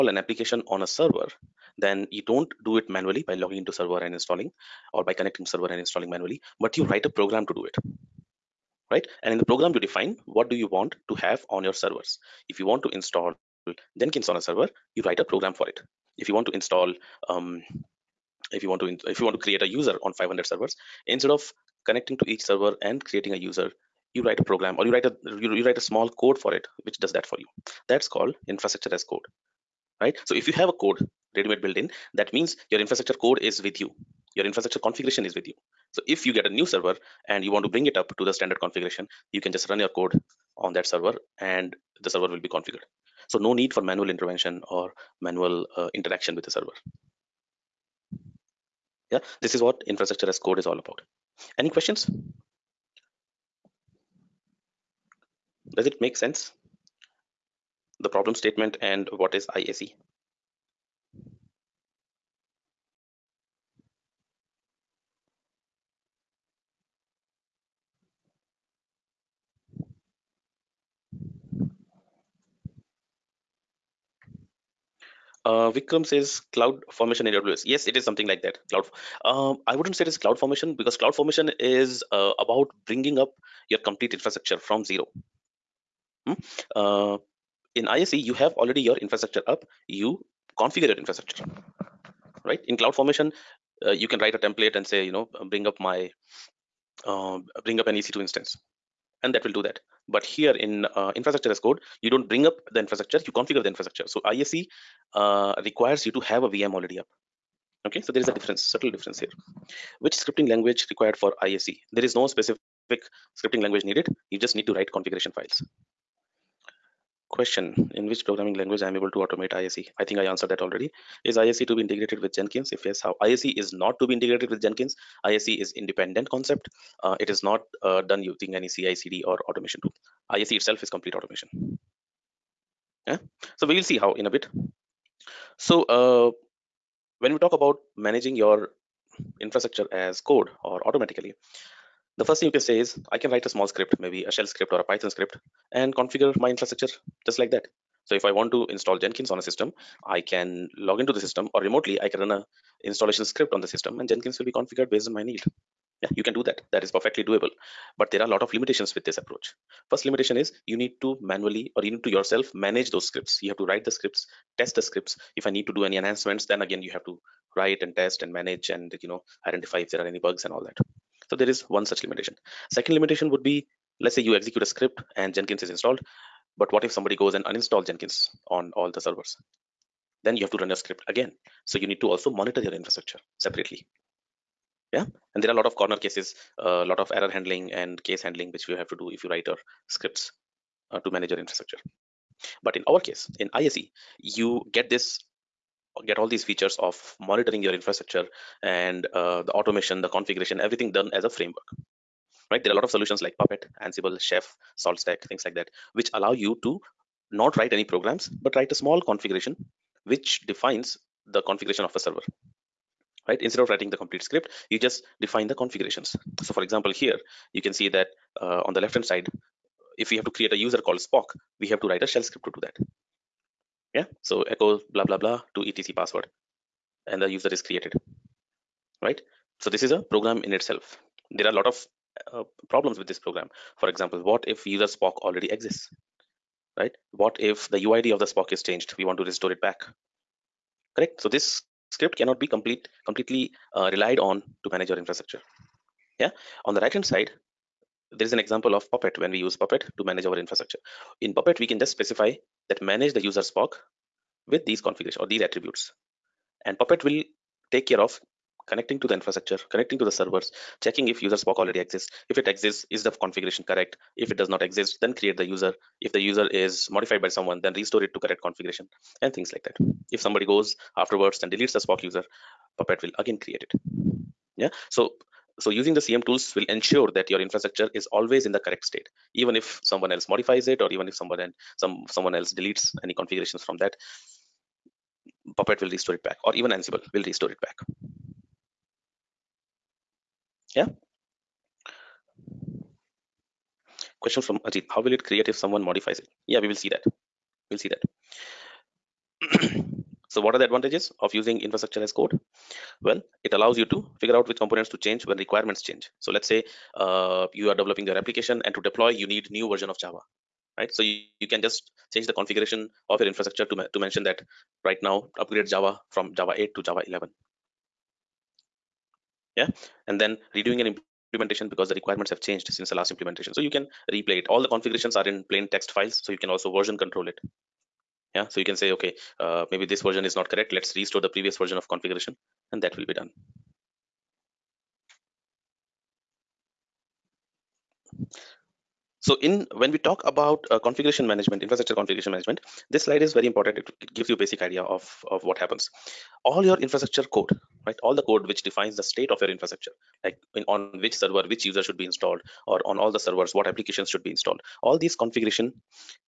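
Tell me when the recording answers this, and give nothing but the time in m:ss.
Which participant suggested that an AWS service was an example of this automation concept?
1:15.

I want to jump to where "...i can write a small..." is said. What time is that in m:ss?
2:23.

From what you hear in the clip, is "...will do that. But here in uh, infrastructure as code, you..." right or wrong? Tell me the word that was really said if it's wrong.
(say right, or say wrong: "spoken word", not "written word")
right.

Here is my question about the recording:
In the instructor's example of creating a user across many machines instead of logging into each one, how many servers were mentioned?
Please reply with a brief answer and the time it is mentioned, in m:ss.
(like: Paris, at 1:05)
500, at 0:20.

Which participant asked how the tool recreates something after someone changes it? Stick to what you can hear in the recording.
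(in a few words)
Ajit.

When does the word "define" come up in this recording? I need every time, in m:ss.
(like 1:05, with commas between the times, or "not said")
0:09, 3:30, 3:35, 5:48.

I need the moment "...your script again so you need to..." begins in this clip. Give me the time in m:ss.
3:00.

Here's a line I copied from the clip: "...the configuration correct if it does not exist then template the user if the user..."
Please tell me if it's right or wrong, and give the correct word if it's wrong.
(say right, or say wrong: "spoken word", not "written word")
wrong: "create", not "template".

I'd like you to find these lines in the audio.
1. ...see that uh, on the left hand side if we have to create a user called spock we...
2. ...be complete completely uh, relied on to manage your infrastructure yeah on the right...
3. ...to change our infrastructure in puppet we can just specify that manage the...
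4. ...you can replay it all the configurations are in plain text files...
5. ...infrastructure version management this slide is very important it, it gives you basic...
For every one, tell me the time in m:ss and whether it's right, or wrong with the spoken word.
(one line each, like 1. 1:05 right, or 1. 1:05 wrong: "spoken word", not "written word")
1. 3:37 right
2. 4:02 right
3. 4:09 wrong: "manage", not "change"
4. 5:23 right
5. 5:41 wrong: "configuration", not "version".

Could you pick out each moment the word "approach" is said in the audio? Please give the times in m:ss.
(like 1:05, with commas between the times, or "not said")
2:39.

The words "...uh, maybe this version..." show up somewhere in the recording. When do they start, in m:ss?
5:29.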